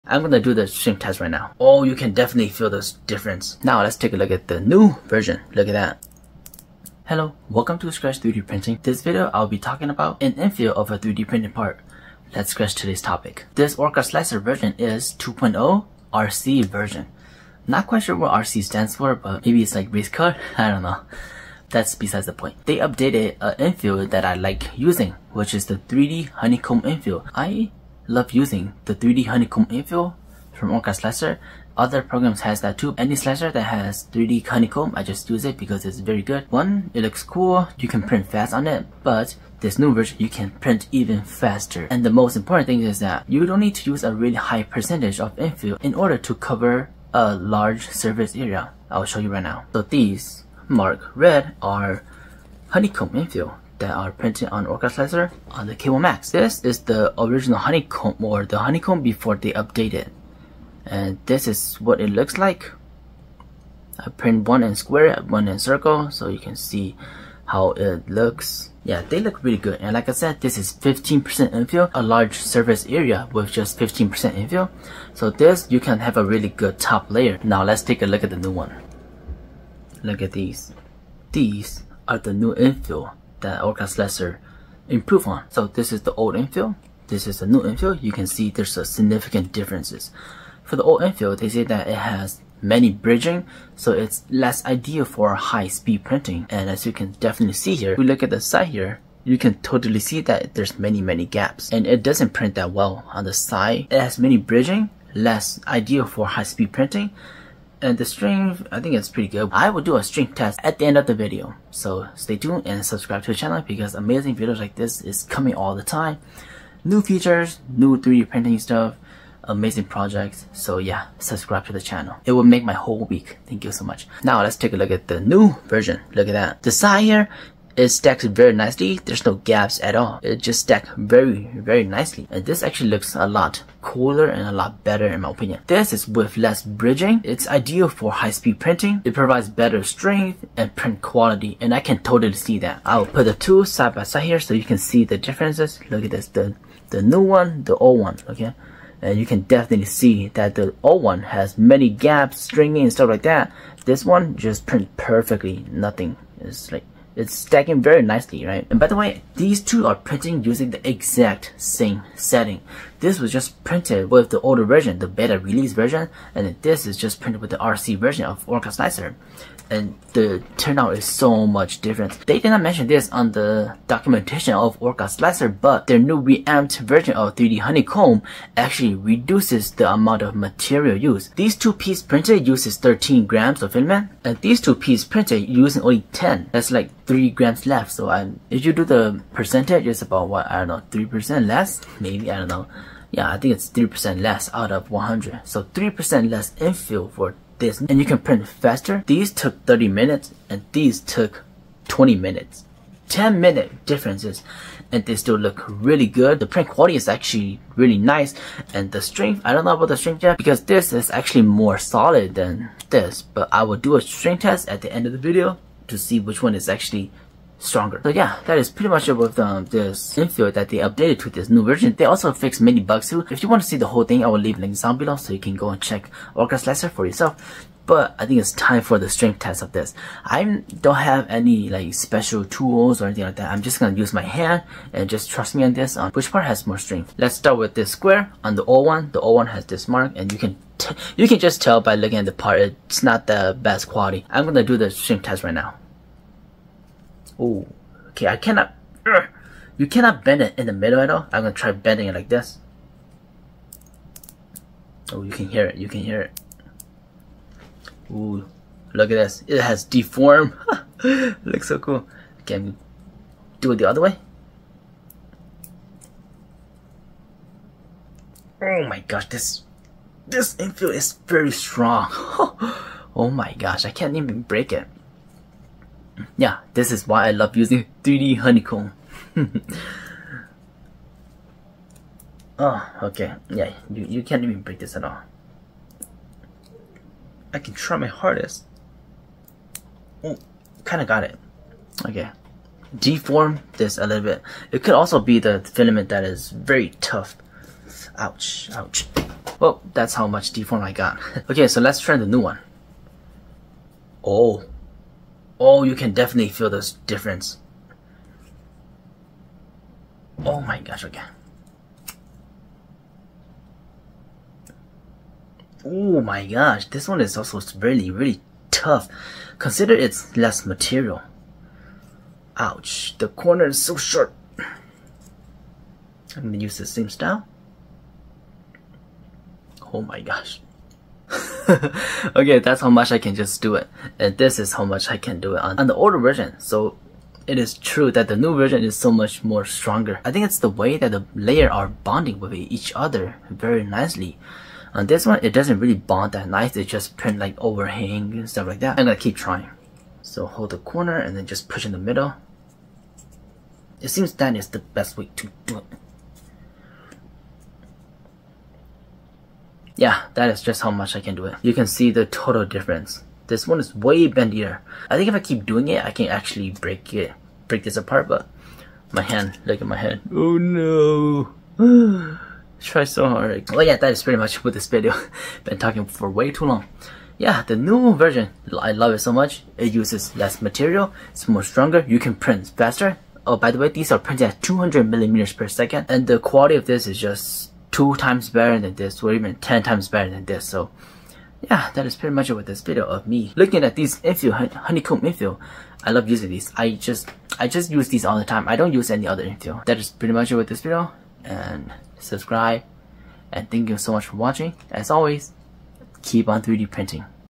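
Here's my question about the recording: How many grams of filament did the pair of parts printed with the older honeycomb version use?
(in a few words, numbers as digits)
13 grams.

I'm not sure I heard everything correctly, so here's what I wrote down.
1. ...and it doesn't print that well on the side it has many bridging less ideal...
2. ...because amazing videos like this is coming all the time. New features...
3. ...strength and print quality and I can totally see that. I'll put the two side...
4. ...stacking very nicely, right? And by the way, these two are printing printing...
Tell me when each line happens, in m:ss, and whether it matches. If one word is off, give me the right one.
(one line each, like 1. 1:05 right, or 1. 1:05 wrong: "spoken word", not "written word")
1. 1:41 right
2. 1:53 right
3. 2:19 right
4. 2:37 wrong: "using", not "printing".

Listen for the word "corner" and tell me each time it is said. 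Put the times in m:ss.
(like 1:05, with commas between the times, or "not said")
5:23, 5:50.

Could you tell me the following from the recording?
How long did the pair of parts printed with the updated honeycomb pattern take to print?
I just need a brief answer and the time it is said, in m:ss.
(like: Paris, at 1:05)
20 minutes, at 3:21.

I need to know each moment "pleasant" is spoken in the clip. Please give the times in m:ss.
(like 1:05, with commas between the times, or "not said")
not said.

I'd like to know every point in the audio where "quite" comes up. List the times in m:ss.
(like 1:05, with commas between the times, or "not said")
0:17.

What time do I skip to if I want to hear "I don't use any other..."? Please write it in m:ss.
6:38.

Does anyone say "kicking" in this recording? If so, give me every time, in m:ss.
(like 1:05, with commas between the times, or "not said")
not said.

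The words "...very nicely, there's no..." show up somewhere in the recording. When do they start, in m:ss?
2:08.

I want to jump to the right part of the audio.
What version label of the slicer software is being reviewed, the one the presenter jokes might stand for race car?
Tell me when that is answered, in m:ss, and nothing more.
0:15.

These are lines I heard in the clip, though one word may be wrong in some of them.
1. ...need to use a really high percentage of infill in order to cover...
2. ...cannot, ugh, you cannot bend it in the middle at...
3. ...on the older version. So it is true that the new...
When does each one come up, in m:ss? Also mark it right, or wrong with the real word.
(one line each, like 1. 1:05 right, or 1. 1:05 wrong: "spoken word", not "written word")
1. 0:43 right
2. 4:08 right
3. 5:35 right.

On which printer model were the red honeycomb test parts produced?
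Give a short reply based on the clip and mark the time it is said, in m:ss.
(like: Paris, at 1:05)
K1 Max, at 0:55.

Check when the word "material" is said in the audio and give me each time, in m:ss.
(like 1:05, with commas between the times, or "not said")
3:00, 5:20, 6:20.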